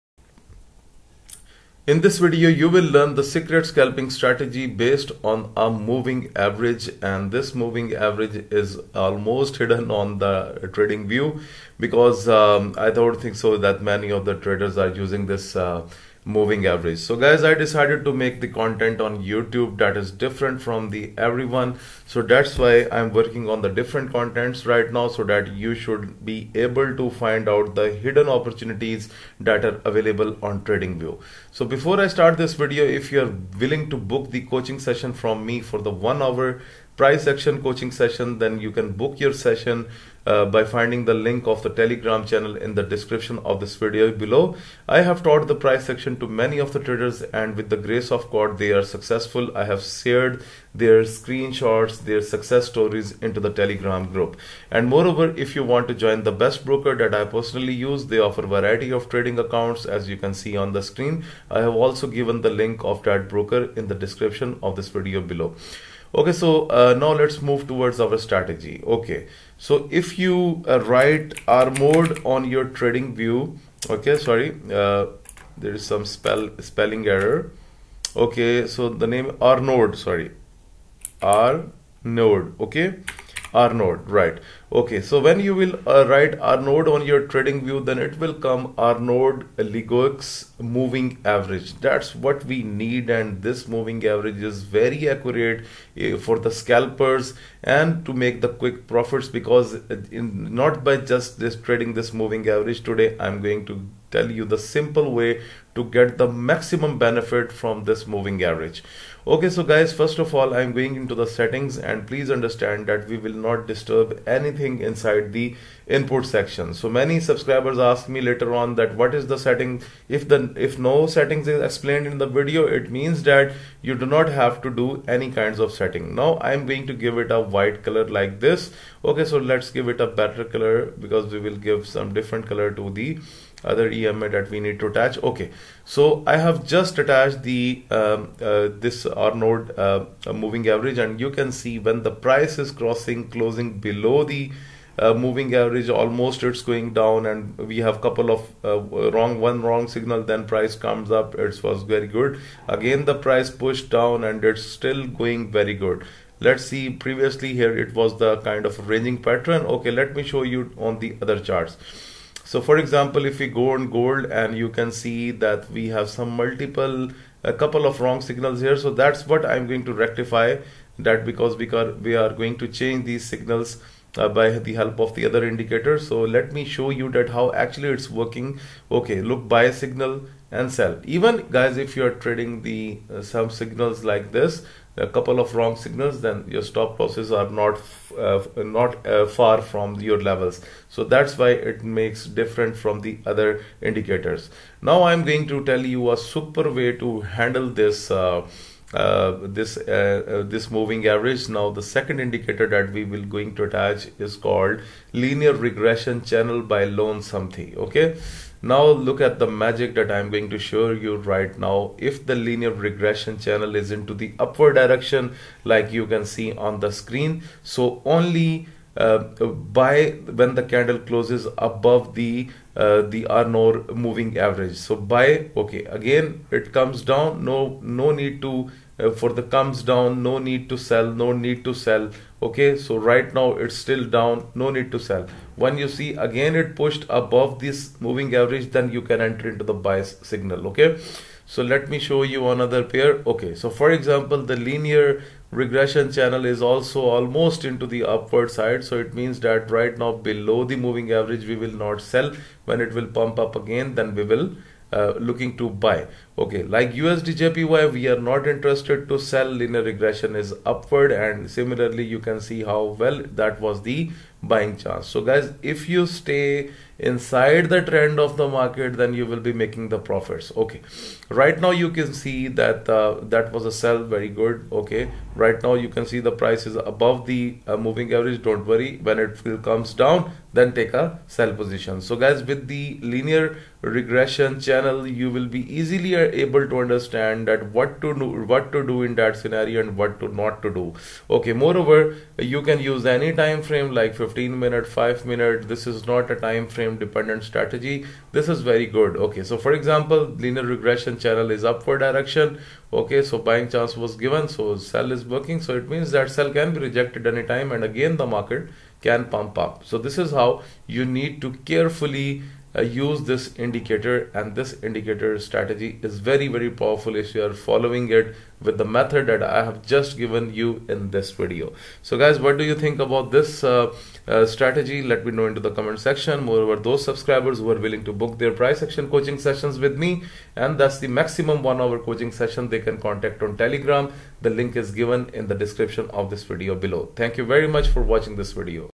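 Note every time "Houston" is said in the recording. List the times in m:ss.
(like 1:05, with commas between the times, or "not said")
not said.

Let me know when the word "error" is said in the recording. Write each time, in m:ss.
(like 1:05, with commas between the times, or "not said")
1:17.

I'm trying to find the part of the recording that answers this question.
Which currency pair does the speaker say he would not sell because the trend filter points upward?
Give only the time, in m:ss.
4:17.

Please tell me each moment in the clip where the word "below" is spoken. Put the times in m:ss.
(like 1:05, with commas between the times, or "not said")
0:44, 1:05, 2:23, 4:10, 5:36.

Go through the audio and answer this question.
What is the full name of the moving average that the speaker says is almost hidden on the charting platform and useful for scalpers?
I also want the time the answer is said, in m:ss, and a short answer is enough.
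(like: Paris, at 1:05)
Arnaud Legoux moving average, at 1:28.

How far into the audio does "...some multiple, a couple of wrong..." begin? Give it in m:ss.
2:46.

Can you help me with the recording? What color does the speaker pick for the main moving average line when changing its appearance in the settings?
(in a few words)
White.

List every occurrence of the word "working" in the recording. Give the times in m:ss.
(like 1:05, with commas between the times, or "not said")
0:23, 2:58, 5:05.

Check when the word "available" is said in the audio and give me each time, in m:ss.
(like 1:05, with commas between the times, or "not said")
0:29.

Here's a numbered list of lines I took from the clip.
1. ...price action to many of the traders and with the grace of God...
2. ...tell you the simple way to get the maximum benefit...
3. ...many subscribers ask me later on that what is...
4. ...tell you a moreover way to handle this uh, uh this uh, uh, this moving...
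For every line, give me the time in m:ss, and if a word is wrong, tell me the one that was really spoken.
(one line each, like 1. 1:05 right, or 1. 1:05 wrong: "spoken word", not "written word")
1. 0:45 right
2. 1:44 right
3. 1:56 right
4. 3:15 wrong: "super", not "moreover".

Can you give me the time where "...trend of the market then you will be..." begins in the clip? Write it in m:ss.
4:27.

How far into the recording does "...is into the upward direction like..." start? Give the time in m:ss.
3:33.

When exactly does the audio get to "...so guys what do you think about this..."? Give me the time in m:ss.
5:22.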